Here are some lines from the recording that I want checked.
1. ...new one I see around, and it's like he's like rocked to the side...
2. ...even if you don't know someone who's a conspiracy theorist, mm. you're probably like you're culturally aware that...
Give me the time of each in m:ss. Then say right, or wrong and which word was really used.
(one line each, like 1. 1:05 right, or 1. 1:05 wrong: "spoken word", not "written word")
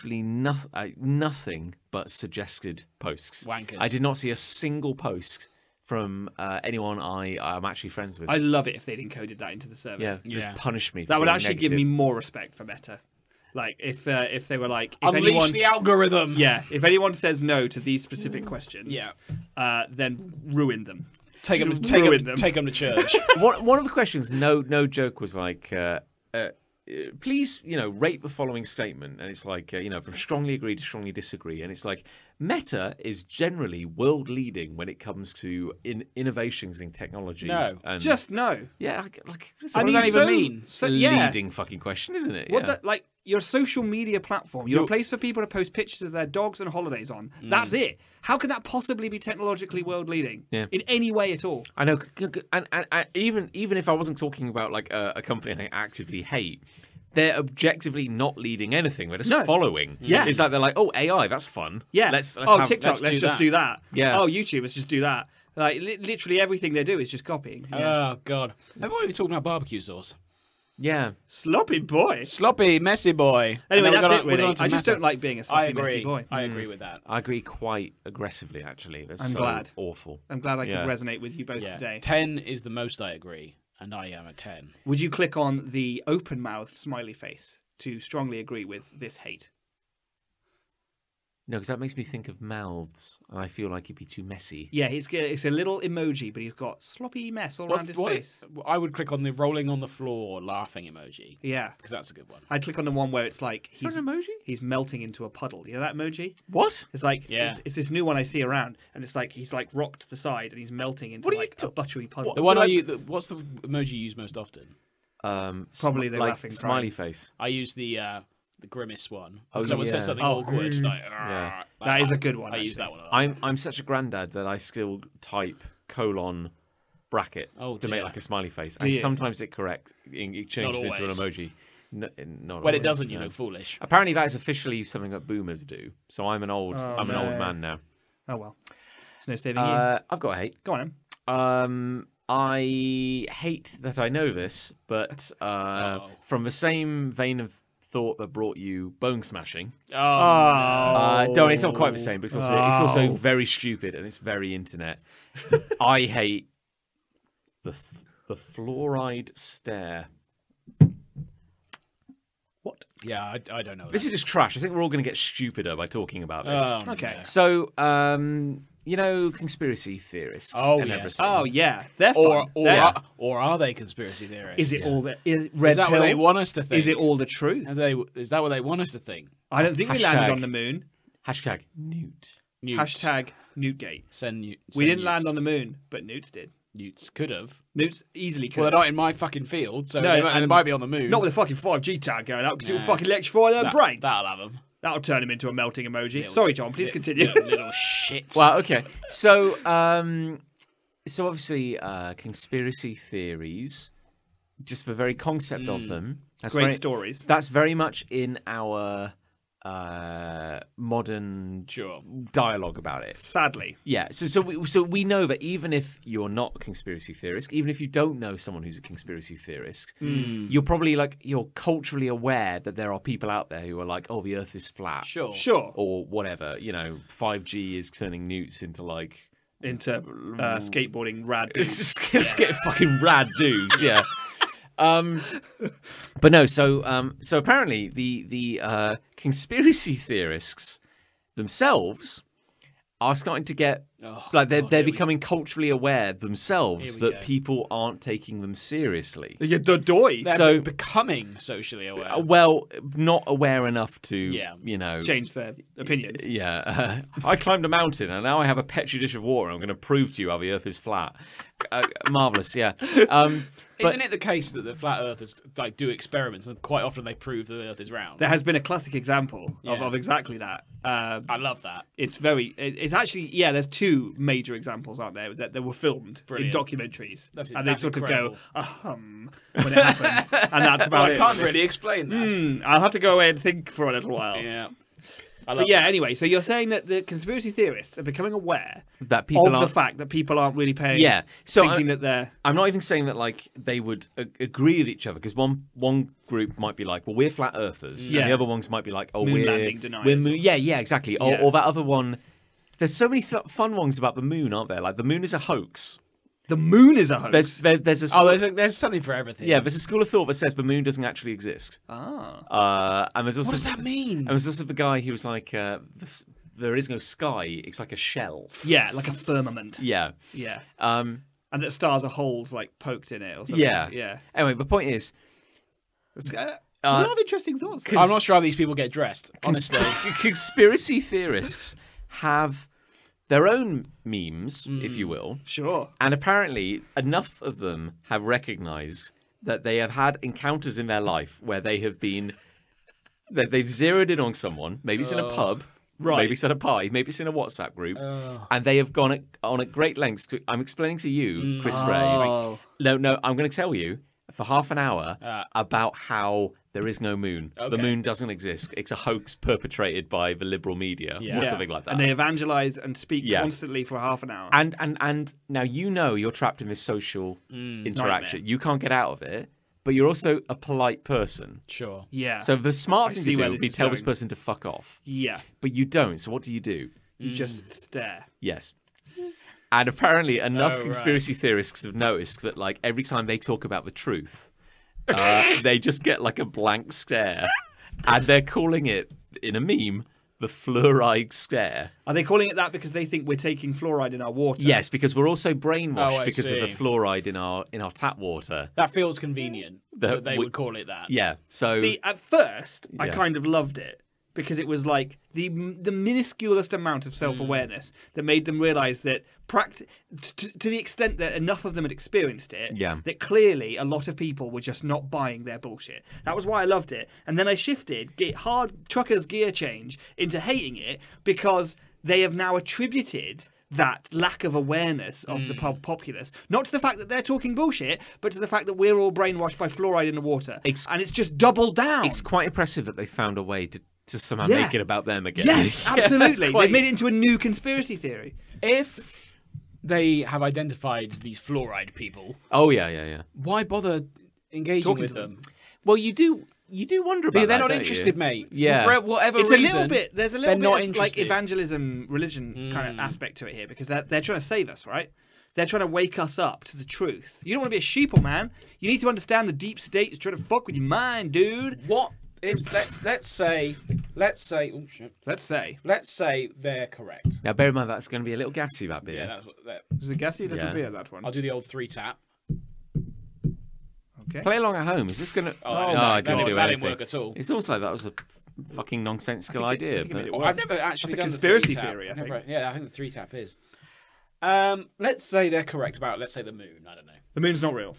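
1. 1:47 right
2. 3:37 right.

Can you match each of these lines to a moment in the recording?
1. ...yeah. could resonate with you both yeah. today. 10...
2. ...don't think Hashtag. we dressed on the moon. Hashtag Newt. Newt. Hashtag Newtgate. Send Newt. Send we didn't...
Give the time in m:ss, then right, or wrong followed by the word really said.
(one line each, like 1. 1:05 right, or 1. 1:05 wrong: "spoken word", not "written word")
1. 1:20 right
2. 2:59 wrong: "landed", not "dressed".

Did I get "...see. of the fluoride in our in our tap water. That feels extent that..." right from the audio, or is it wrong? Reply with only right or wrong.
wrong.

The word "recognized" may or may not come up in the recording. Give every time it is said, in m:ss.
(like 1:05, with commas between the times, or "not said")
5:38.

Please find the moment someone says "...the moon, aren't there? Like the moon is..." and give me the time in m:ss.
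5:04.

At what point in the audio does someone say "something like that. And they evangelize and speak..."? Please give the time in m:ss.
6:01.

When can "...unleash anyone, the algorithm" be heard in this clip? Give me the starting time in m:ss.
0:15.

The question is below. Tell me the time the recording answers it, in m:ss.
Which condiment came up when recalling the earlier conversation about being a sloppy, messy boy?
1:09.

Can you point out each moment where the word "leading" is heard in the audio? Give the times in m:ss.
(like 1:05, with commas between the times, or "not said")
0:34, 0:41, 0:50, 0:58.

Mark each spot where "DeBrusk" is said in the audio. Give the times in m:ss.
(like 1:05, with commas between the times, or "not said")
not said.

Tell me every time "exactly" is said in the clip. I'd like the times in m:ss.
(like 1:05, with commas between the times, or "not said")
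4:29, 5:00.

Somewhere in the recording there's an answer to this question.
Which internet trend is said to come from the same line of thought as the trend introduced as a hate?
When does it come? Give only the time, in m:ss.
2:28.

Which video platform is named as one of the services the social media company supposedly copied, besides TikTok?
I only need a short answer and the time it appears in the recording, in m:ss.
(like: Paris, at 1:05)
YouTube, at 1:04.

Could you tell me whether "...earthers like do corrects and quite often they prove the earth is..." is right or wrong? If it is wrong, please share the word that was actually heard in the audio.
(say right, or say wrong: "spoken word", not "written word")
wrong: "experiments", not "corrects".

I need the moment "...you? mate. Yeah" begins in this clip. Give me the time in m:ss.
7:28.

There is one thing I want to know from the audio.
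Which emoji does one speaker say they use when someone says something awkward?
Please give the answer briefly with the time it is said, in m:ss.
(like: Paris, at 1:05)
the grimace one, at 1:58.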